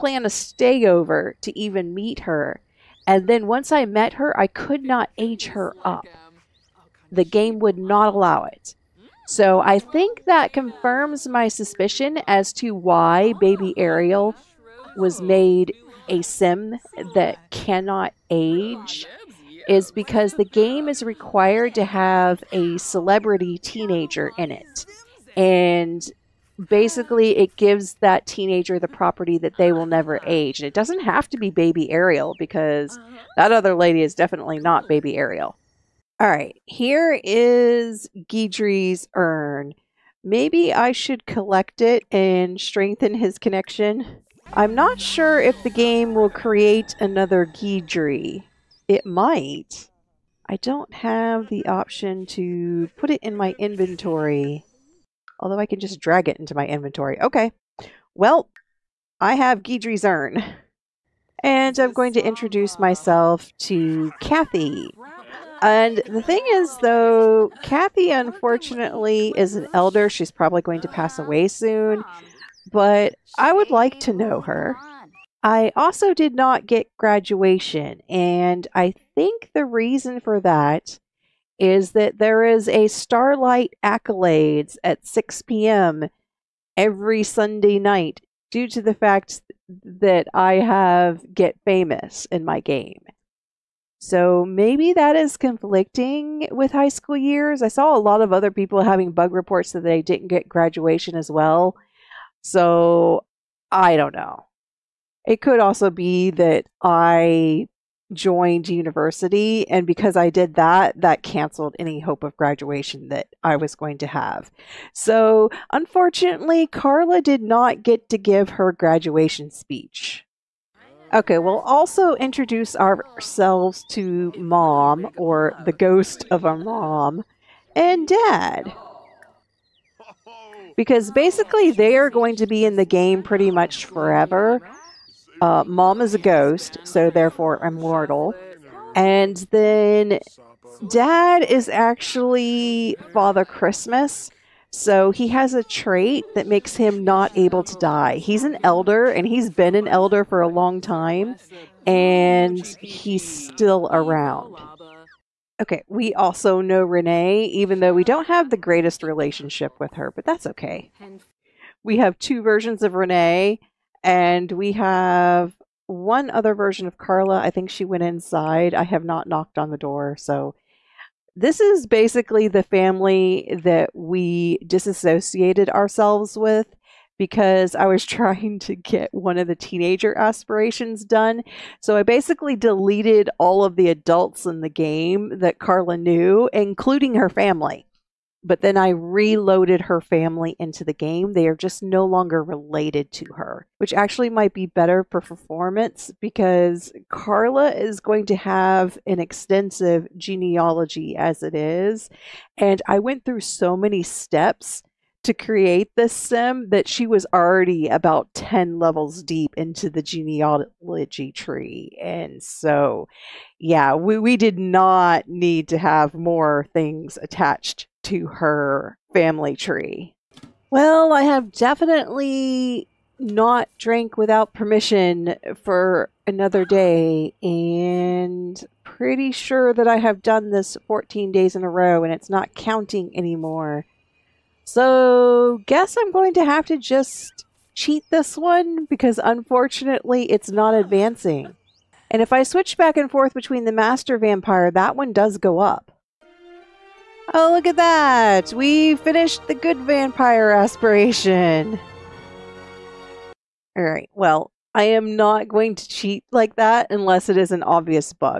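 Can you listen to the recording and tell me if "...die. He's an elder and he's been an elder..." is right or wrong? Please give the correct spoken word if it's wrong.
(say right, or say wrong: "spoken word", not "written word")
right.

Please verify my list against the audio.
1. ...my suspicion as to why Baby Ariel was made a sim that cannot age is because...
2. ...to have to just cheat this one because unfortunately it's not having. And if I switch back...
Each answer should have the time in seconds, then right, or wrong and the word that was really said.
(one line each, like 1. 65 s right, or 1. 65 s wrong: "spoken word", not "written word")
1. 11 s right
2. 236 s wrong: "advancing", not "having".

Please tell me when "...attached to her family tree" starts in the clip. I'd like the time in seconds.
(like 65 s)
217 s.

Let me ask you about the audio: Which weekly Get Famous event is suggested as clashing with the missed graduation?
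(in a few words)
Starlight Accolades.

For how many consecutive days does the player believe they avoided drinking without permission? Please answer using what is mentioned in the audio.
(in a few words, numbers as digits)
14.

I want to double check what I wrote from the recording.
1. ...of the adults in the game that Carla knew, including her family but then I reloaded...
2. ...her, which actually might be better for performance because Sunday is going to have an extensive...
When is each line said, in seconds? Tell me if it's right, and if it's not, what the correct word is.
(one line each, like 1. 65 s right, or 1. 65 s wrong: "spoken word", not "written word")
1. 183 s right
2. 193 s wrong: "Carla", not "Sunday".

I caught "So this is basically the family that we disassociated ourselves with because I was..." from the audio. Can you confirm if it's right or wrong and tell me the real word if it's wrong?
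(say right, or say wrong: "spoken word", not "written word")
right.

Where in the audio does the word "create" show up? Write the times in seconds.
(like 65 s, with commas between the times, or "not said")
46 s, 205 s.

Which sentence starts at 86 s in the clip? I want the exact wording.
every Sunday night due to the fact that I have Get Famous in my game.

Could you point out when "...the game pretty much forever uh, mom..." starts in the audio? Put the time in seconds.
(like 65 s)
132 s.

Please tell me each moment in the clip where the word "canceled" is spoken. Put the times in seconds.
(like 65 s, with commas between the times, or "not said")
111 s.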